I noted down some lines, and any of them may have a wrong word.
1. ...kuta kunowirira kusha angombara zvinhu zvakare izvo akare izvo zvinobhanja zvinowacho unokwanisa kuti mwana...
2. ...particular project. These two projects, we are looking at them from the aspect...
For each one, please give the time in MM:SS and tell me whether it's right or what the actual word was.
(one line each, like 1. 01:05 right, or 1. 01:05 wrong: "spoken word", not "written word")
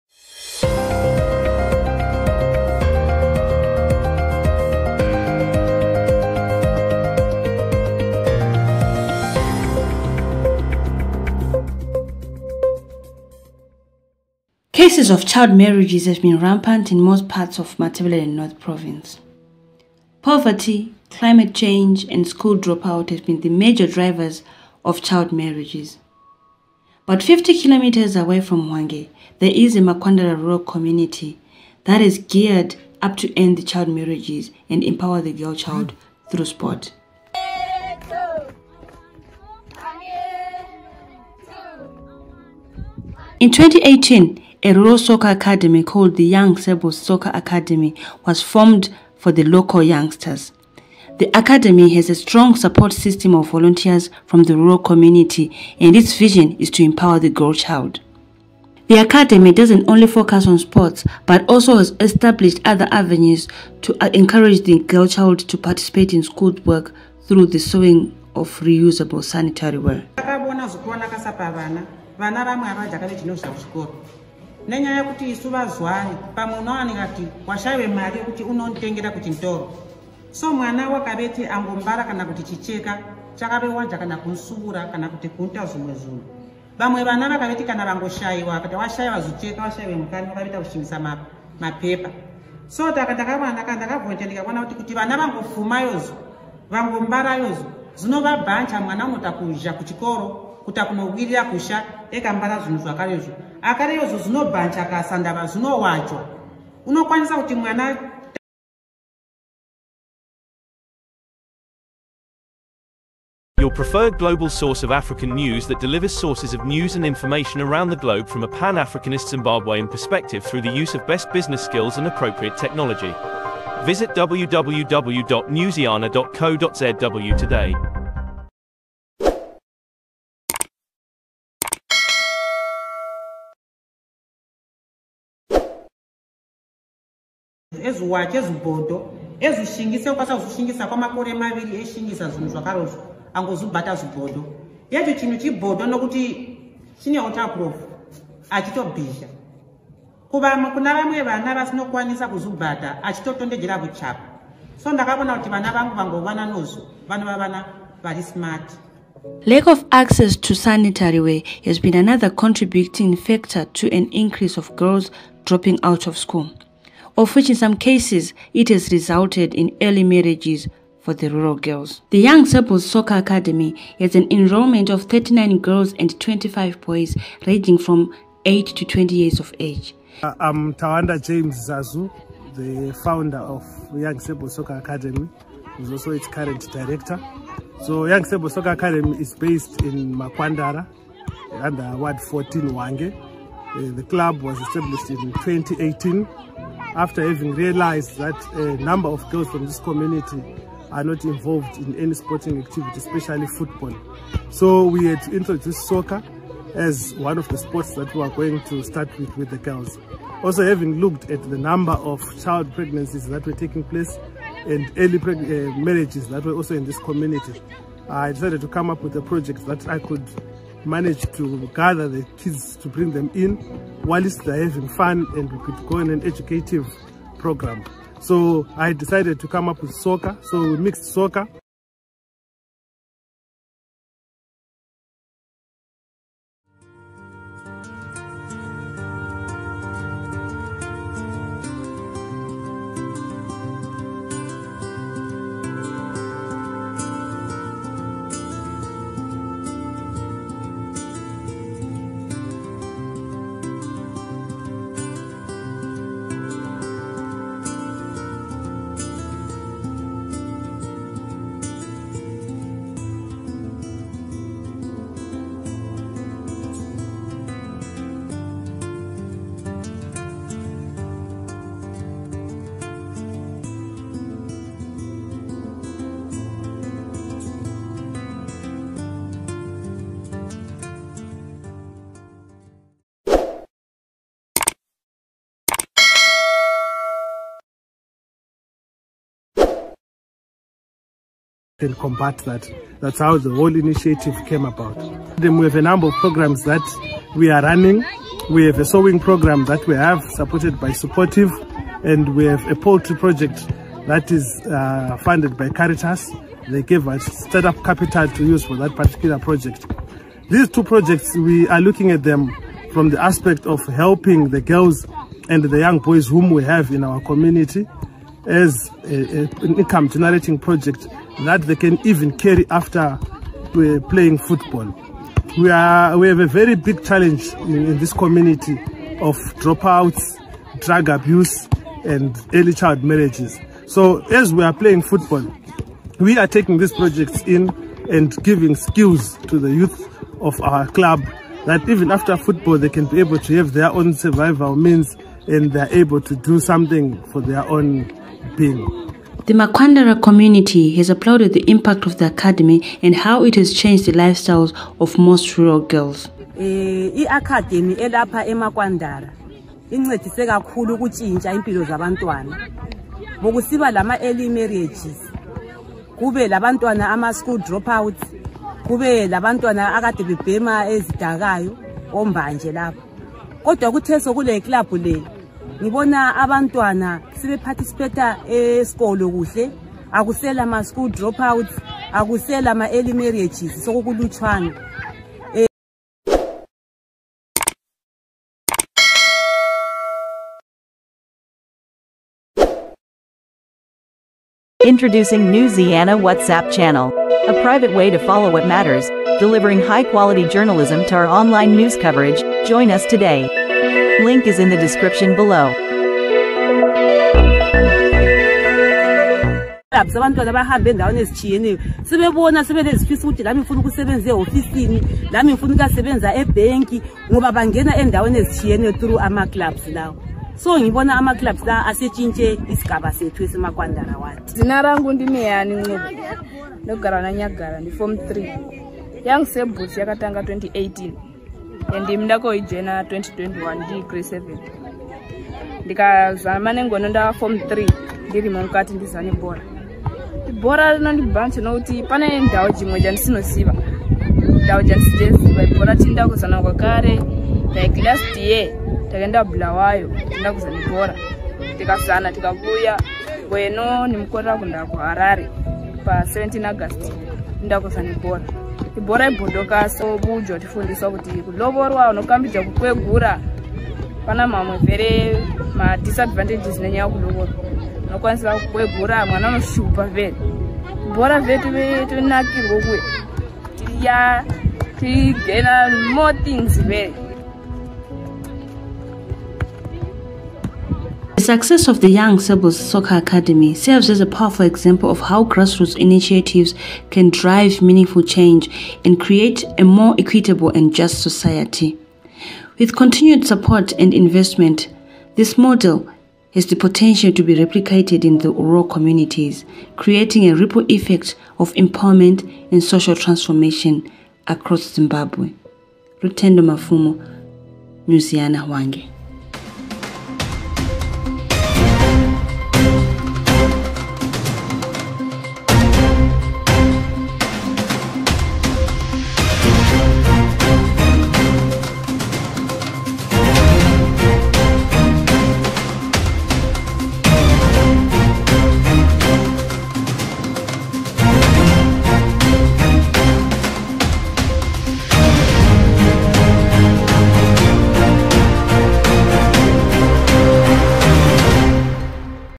1. 01:40 wrong: "ekambara", not "angombara"
2. 05:08 right.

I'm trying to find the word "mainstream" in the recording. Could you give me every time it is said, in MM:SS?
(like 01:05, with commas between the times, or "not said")
not said.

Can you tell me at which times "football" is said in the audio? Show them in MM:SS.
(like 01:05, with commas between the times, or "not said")
03:23, 05:24, 05:35, 05:42.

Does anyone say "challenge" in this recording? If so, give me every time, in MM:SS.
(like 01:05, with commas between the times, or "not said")
05:27.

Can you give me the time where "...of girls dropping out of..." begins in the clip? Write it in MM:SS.
02:44.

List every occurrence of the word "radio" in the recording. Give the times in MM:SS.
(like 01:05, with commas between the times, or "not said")
not said.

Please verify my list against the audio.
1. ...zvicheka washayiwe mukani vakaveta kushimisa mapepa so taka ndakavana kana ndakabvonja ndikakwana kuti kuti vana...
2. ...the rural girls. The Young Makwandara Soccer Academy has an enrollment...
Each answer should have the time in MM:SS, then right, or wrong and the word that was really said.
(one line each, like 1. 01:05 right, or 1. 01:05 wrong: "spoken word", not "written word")
1. 01:29 right
2. 02:51 wrong: "Sebles", not "Makwandara".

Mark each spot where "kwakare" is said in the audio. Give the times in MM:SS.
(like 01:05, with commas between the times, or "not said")
07:26.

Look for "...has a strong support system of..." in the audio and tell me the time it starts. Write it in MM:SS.
00:51.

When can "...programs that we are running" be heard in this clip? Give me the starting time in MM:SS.
04:56.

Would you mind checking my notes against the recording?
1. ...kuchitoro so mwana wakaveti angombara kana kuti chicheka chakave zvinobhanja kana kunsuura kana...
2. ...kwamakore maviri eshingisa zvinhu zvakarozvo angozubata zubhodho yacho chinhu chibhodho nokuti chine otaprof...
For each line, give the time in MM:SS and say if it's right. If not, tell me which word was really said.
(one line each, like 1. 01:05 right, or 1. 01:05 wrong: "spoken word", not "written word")
1. 01:19 wrong: "wanja", not "zvinobhanja"
2. 02:20 right.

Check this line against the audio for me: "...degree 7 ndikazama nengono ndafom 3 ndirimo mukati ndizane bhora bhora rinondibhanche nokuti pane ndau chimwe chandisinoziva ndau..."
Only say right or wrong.
right.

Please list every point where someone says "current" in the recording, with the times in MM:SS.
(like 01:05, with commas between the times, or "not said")
03:06.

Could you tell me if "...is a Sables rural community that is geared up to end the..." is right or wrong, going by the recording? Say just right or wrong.
wrong.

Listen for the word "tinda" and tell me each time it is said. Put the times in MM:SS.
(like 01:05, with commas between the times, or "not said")
07:25, 07:30.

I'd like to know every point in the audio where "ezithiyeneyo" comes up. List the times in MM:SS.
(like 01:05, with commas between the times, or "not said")
06:51, 06:58.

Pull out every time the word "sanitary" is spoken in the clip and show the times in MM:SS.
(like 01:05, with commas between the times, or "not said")
01:09, 02:40.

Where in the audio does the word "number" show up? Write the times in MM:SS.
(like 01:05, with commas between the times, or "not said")
03:18, 03:31, 04:55.